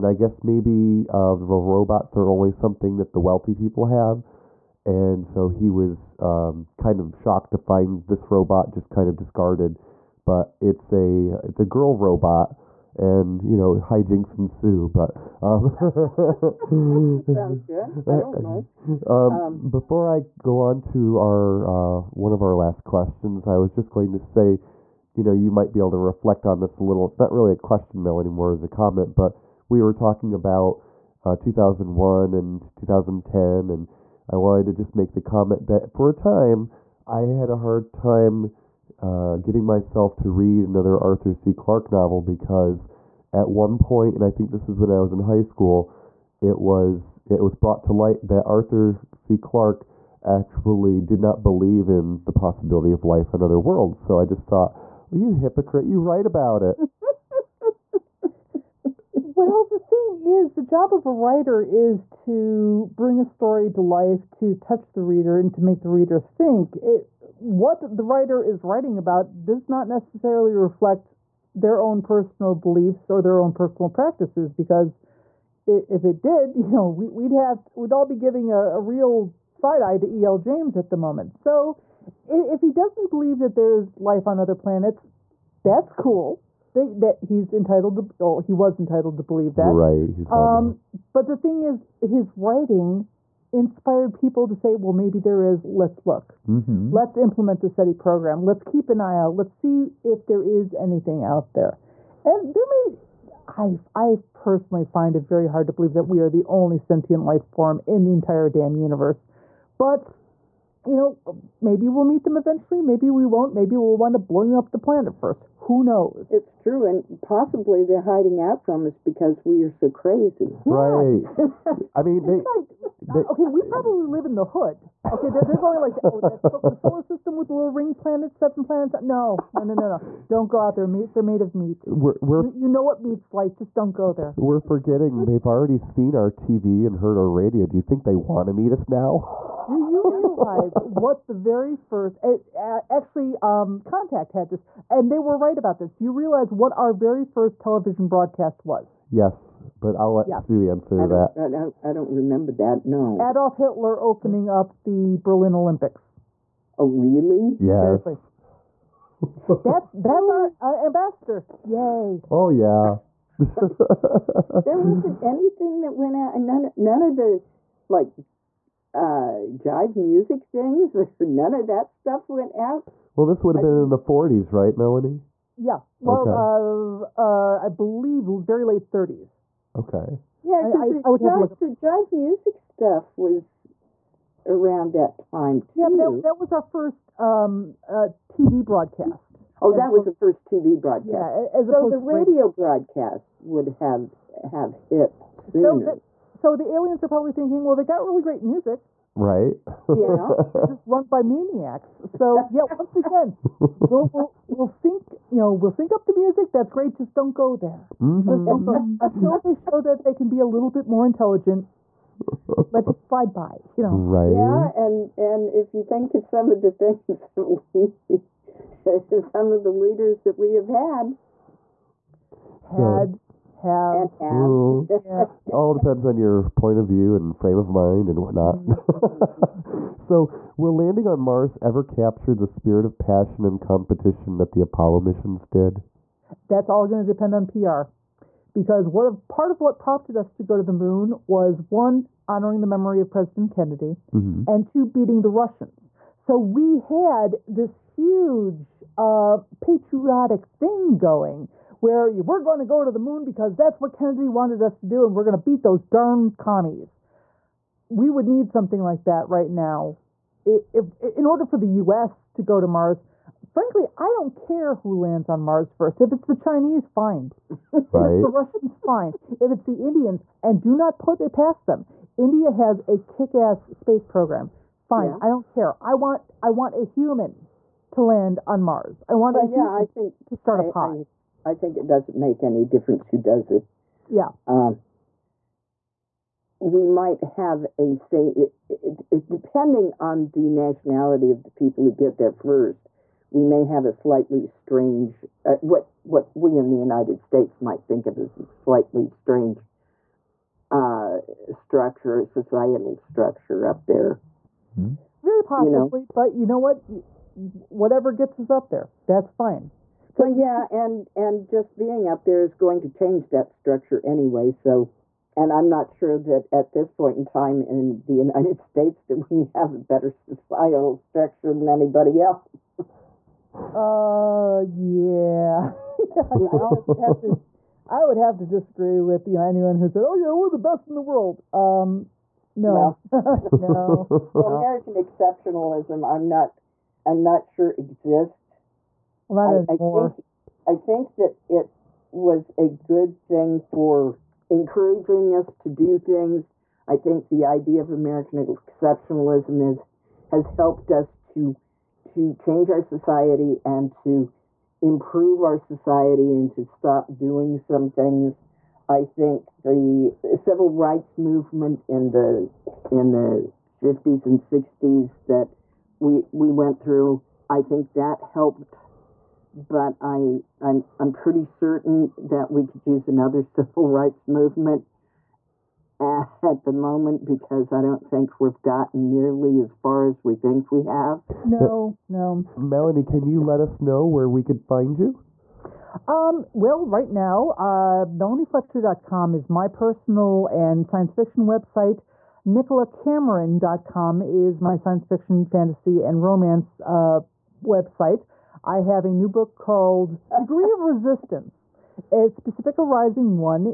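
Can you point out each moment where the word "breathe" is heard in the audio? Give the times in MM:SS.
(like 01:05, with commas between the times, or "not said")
not said.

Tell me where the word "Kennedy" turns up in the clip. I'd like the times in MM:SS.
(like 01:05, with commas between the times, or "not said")
04:03, 04:13.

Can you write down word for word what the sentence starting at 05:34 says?
Well, American exceptionalism, I'm not, I'm not sure exists.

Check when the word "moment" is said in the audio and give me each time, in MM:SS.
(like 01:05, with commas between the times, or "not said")
01:20, 06:16.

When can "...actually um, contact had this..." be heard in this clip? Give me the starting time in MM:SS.
02:22.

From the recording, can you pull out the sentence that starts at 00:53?
So I just thought, well, you hypocrite, you write about it.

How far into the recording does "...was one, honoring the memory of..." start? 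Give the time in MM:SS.
04:01.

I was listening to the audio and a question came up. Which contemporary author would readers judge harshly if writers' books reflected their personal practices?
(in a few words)
E.L. James.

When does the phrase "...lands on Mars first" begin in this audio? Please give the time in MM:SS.
04:24.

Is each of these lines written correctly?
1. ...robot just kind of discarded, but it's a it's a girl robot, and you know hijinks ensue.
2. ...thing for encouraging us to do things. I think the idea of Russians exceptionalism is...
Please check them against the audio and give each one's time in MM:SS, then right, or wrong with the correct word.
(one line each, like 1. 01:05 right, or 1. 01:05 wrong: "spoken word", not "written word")
1. 00:08 right
2. 05:43 wrong: "American", not "Russians".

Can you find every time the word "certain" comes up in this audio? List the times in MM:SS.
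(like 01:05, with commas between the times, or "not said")
06:11.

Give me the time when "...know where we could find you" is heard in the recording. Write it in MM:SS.
06:23.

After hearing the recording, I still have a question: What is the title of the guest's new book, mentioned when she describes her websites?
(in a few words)
Degree of Resistance.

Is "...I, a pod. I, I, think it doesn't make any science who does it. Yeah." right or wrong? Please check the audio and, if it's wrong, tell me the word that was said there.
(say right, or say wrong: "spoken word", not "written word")
wrong: "difference", not "science".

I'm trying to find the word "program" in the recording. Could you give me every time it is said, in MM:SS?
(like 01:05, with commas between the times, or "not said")
01:37, 04:34.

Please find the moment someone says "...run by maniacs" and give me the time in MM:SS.
03:20.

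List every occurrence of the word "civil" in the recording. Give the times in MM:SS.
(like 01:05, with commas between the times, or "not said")
06:00, 06:13.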